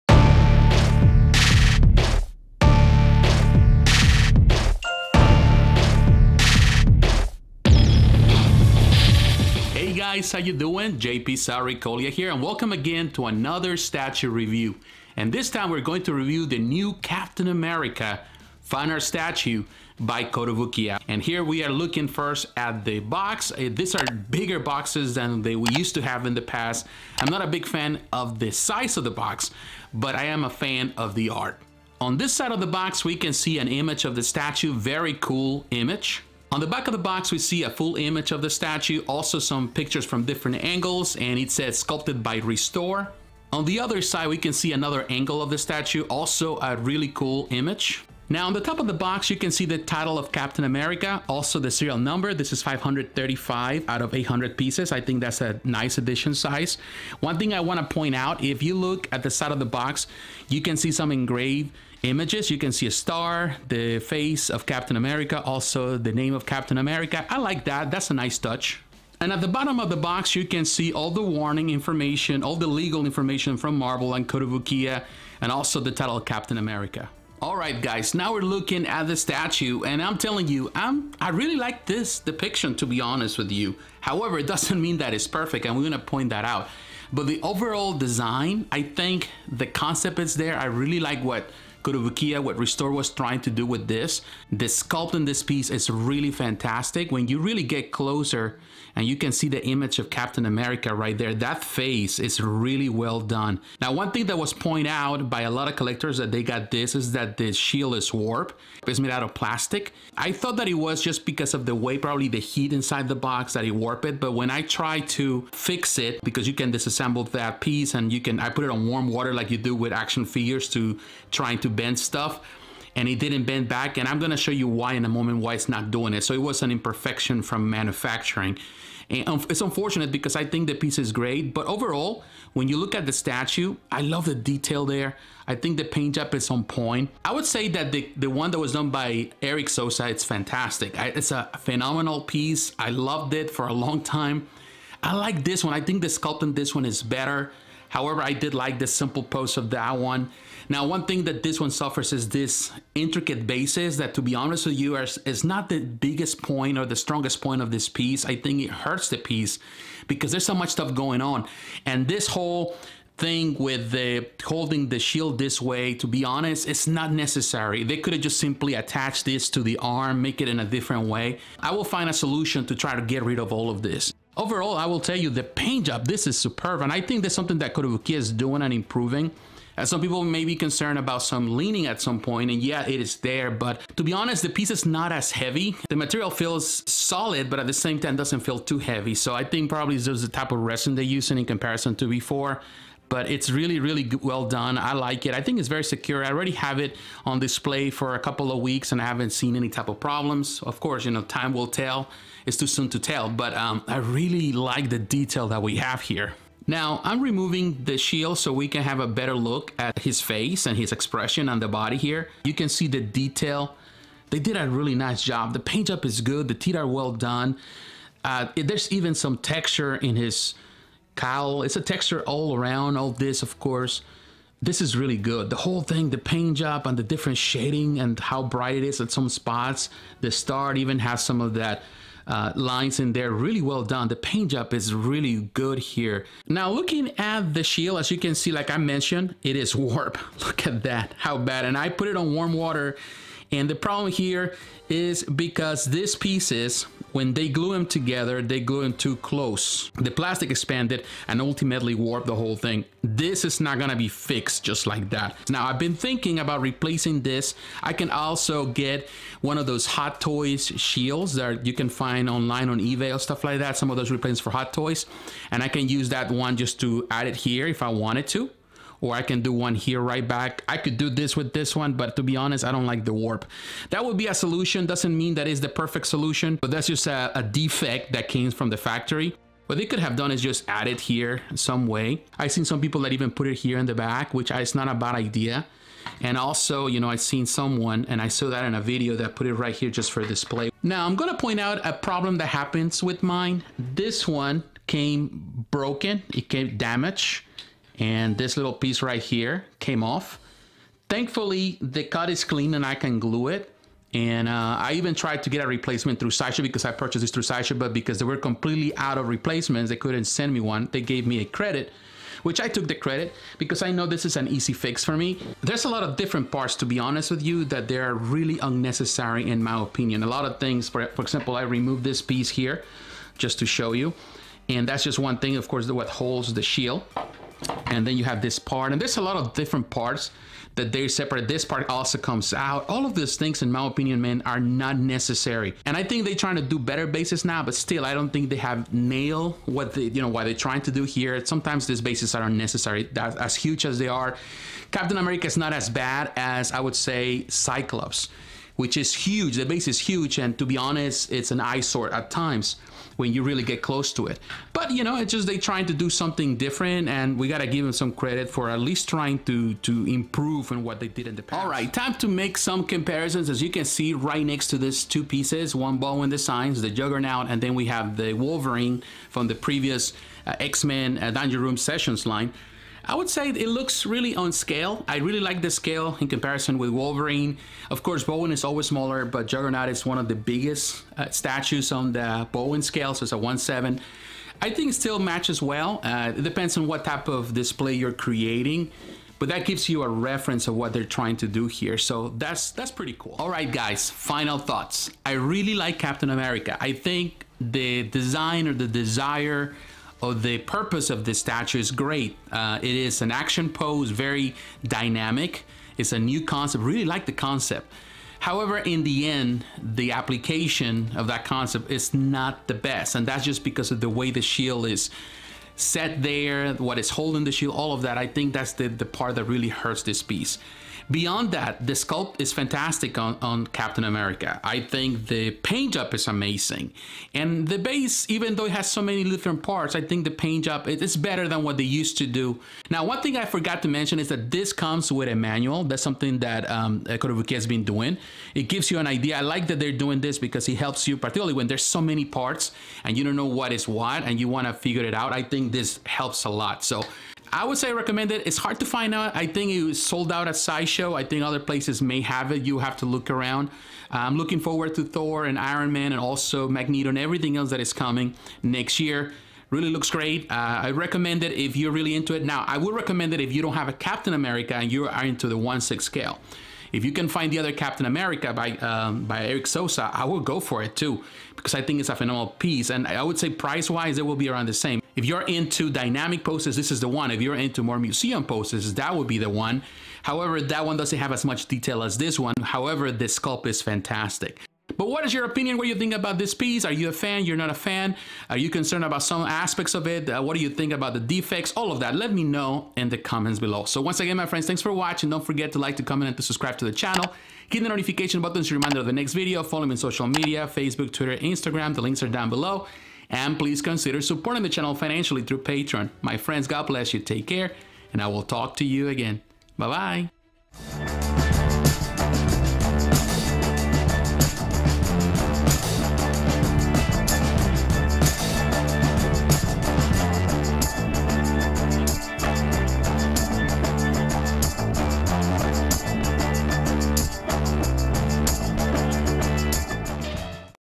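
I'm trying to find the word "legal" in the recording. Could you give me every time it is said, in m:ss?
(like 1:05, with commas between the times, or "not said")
1:12.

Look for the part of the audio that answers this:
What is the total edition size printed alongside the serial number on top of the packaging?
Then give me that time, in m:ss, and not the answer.
0:54.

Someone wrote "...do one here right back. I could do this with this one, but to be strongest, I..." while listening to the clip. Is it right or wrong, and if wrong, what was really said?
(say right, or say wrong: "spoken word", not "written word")
wrong: "honest", not "strongest".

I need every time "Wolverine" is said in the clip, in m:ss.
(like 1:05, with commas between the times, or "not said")
6:08, 6:16.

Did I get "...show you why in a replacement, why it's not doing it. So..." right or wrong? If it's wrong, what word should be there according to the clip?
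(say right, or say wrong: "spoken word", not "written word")
wrong: "moment", not "replacement".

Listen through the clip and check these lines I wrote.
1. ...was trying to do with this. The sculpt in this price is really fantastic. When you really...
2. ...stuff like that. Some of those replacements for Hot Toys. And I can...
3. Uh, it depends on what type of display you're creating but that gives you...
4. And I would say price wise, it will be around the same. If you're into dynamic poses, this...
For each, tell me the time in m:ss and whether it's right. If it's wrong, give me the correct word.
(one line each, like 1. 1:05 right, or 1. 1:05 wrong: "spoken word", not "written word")
1. 1:32 wrong: "piece", not "price"
2. 4:23 right
3. 6:26 right
4. 7:52 right.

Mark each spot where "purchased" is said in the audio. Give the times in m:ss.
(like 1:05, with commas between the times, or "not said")
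5:06.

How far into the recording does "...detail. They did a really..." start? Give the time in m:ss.
3:33.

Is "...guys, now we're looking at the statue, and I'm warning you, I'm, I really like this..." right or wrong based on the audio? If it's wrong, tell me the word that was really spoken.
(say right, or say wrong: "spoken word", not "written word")
wrong: "telling", not "warning".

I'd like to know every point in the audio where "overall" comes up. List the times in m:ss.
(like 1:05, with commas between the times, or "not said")
1:27, 2:11, 2:54.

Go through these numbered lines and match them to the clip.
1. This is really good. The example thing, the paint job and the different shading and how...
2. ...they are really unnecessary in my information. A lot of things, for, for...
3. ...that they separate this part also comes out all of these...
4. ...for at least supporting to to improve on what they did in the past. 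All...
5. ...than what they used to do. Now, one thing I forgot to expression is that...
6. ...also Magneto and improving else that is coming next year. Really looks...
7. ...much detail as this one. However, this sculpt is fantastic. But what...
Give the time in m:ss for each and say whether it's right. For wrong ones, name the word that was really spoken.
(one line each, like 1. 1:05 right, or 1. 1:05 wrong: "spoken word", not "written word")
1. 3:44 wrong: "whole", not "example"
2. 5:17 wrong: "opinion", not "information"
3. 5:30 right
4. 5:58 wrong: "trying", not "supporting"
5. 7:11 wrong: "mention", not "expression"
6. 7:36 wrong: "everything", not "improving"
7. 8:01 right.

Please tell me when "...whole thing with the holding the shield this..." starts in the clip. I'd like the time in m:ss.
2:42.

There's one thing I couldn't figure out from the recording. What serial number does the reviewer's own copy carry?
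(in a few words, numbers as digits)
535.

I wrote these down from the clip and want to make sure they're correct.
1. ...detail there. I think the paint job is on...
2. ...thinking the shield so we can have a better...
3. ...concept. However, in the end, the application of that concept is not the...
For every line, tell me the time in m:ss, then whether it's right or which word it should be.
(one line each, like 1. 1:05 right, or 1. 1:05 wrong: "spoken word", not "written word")
1. 2:14 right
2. 3:27 wrong: "removing", not "thinking"
3. 6:47 right.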